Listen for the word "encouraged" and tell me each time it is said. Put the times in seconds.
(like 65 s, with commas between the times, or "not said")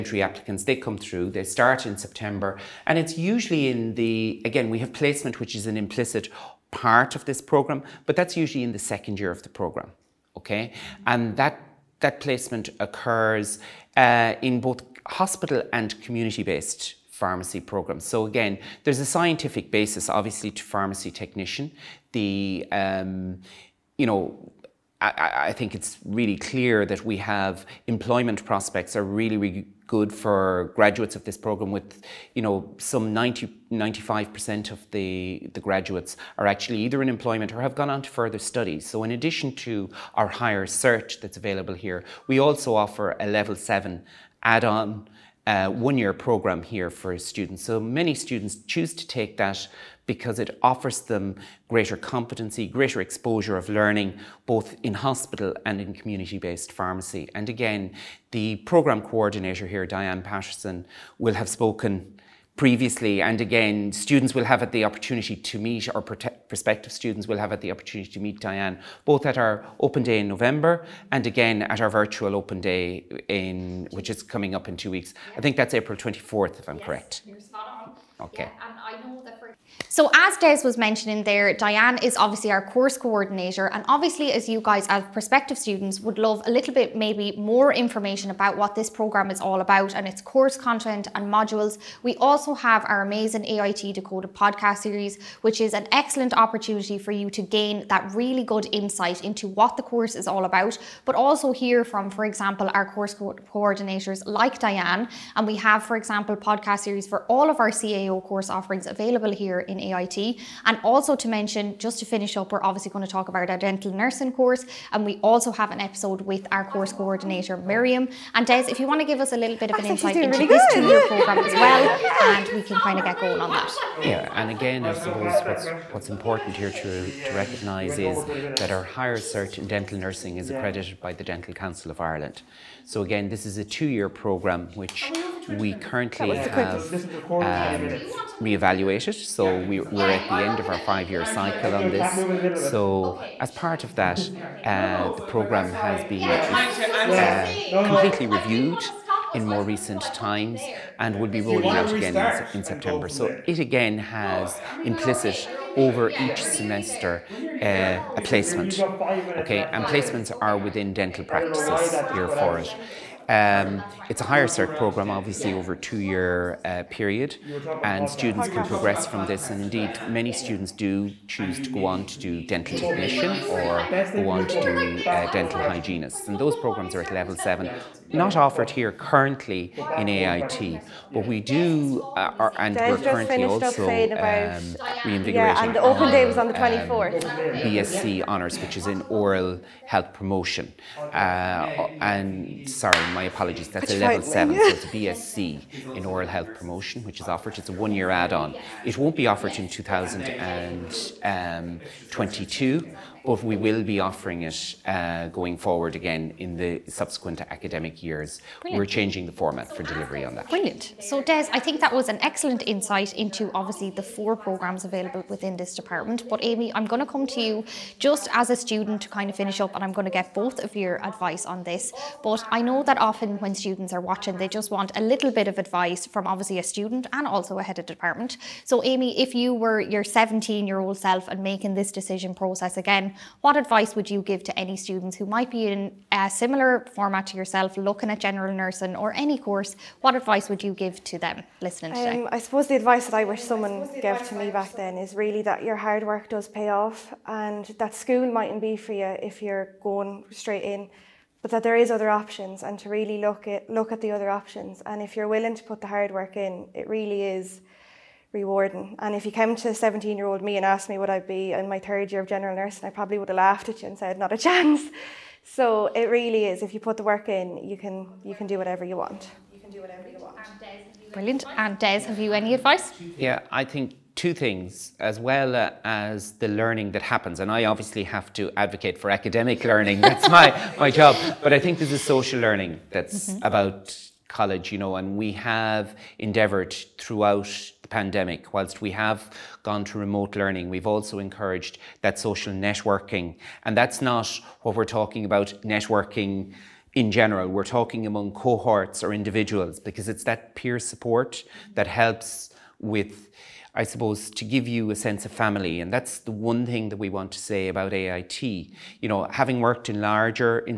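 291 s.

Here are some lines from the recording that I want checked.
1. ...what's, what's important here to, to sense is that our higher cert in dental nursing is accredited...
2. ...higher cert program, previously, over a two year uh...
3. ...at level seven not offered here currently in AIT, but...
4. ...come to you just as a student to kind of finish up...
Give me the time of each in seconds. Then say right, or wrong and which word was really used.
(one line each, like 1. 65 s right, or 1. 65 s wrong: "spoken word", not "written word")
1. 125 s wrong: "recognise", not "sense"
2. 164 s wrong: "obviously", not "previously"
3. 177 s right
4. 217 s right.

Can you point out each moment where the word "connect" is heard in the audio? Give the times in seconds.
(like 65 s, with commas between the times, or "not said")
not said.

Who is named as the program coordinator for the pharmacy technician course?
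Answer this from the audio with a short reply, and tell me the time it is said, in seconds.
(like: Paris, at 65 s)
Diane Patterson, at 59 s.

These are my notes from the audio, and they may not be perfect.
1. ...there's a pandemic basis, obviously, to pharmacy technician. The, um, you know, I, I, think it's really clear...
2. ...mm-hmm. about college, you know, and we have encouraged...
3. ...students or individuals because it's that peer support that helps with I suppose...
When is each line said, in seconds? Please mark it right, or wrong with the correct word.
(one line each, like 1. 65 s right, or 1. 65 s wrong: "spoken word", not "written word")
1. 18 s wrong: "scientific", not "pandemic"
2. 283 s wrong: "endeavoured", not "encouraged"
3. 298 s wrong: "cohorts", not "students".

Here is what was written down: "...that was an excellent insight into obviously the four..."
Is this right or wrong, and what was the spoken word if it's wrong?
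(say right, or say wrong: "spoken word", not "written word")
right.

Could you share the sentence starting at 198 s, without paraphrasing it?
It won't be offered in 2022 um, but we will be offering it uh, going forward again in the subsequent academic years.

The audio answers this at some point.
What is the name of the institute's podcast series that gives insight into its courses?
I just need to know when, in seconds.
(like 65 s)
93 s.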